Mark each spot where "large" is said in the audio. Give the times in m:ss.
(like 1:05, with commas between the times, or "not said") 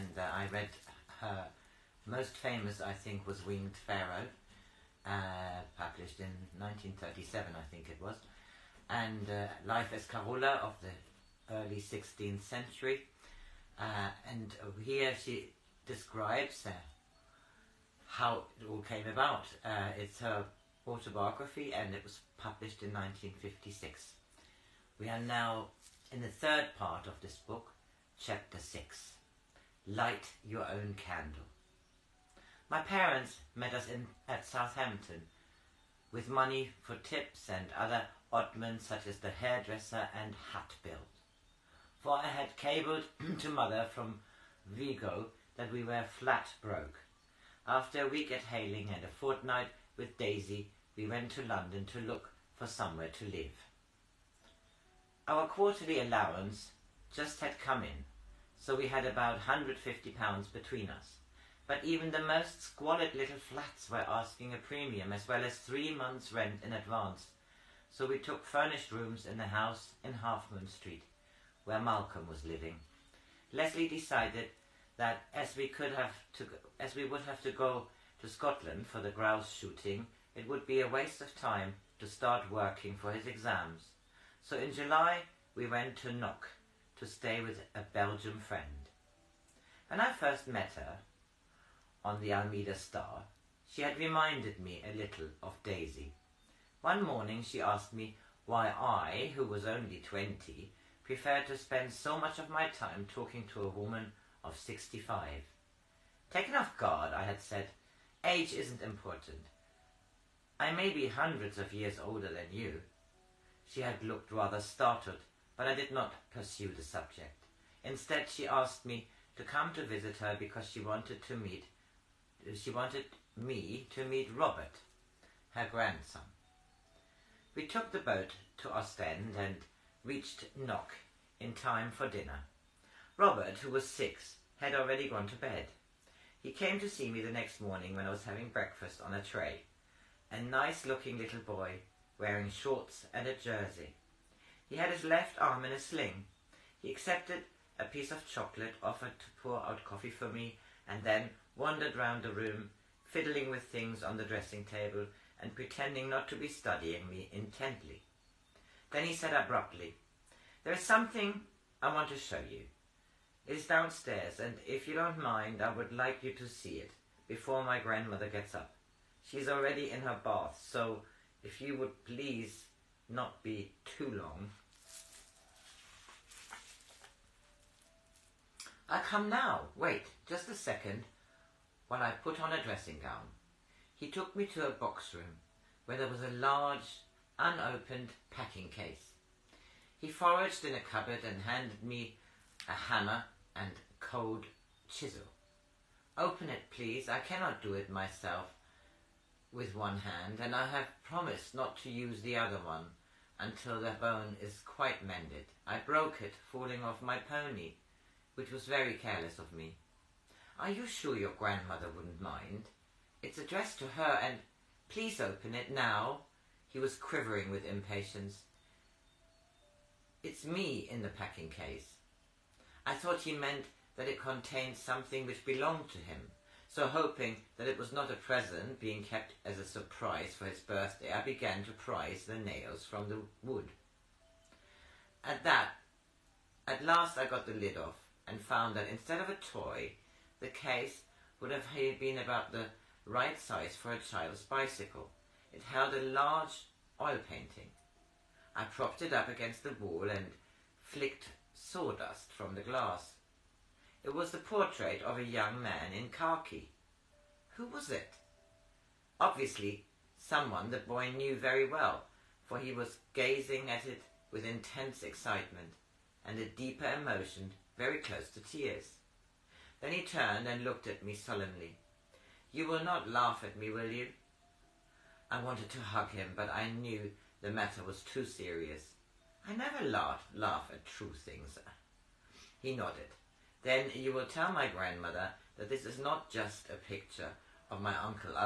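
3:06, 4:06.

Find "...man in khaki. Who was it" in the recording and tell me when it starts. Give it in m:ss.
4:15.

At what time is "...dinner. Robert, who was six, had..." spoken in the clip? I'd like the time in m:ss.
2:12.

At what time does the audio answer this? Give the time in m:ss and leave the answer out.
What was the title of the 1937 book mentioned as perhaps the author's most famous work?
0:03.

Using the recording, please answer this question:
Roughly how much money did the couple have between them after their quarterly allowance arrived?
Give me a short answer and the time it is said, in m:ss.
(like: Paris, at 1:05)
£150, at 0:59.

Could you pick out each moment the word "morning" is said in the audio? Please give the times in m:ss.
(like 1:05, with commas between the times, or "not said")
1:37, 2:17.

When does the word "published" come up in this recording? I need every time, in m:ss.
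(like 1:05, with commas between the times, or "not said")
0:05, 0:22.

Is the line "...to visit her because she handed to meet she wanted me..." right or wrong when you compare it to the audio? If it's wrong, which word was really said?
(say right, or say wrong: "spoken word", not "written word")
wrong: "wanted", not "handed".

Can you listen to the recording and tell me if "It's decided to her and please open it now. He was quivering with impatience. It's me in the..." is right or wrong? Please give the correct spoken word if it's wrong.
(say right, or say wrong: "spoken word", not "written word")
wrong: "addressed", not "decided".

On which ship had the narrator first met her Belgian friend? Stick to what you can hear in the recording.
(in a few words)
Alameda Star.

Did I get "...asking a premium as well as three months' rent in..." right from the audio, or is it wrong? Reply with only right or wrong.
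right.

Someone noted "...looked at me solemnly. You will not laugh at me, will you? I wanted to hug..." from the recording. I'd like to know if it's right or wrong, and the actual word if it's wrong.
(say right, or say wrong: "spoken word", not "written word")
right.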